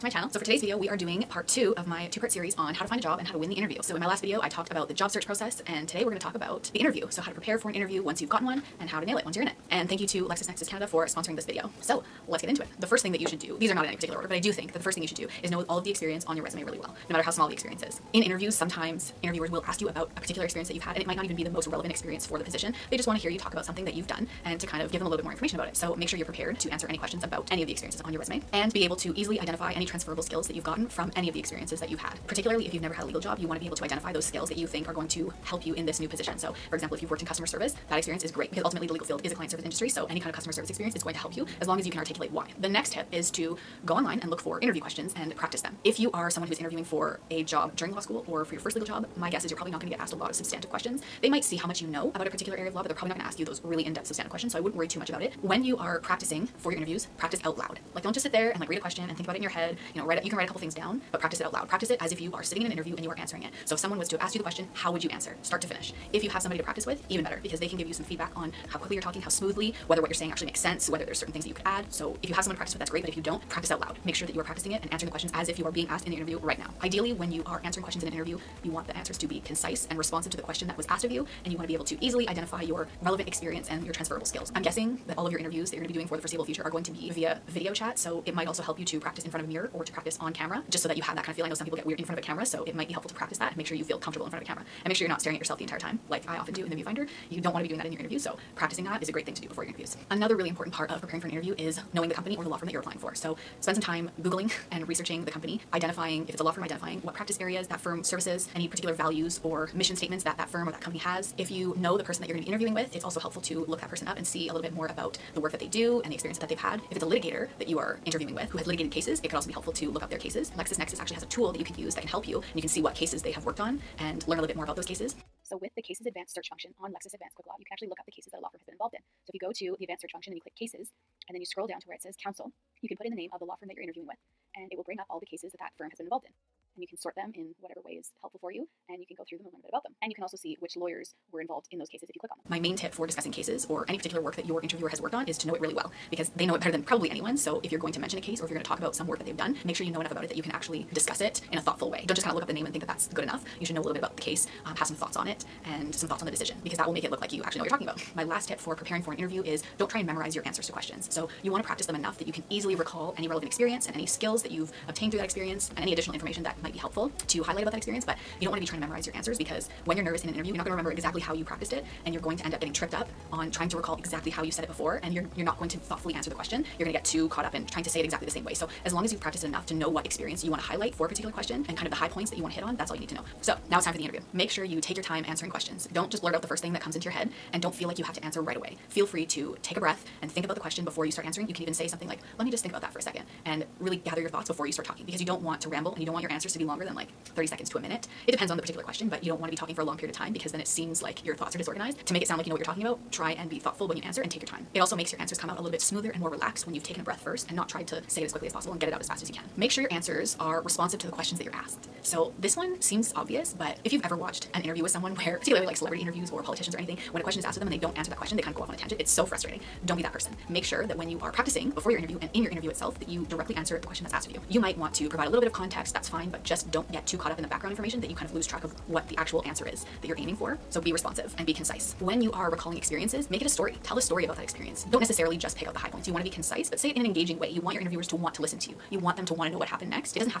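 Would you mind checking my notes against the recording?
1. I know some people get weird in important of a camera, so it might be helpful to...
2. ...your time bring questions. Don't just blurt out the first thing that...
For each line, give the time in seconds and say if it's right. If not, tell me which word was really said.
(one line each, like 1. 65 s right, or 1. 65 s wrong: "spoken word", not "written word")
1. 91 s wrong: "front", not "important"
2. 184 s wrong: "answering", not "bring".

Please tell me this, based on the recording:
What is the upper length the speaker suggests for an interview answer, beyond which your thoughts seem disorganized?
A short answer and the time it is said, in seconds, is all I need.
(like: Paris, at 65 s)
a minute, at 197 s.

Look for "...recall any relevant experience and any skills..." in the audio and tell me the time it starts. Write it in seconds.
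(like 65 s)
162 s.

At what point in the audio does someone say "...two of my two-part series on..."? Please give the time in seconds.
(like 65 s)
1 s.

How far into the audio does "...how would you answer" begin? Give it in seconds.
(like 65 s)
64 s.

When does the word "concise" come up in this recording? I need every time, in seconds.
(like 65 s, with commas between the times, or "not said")
79 s, 231 s, 236 s.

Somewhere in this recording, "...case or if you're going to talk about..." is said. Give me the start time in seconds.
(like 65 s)
148 s.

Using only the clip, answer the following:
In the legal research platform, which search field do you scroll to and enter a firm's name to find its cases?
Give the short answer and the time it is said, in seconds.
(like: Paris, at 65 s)
counsel, at 132 s.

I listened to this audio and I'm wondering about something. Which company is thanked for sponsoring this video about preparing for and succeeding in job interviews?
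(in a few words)
LexisNexis Canada.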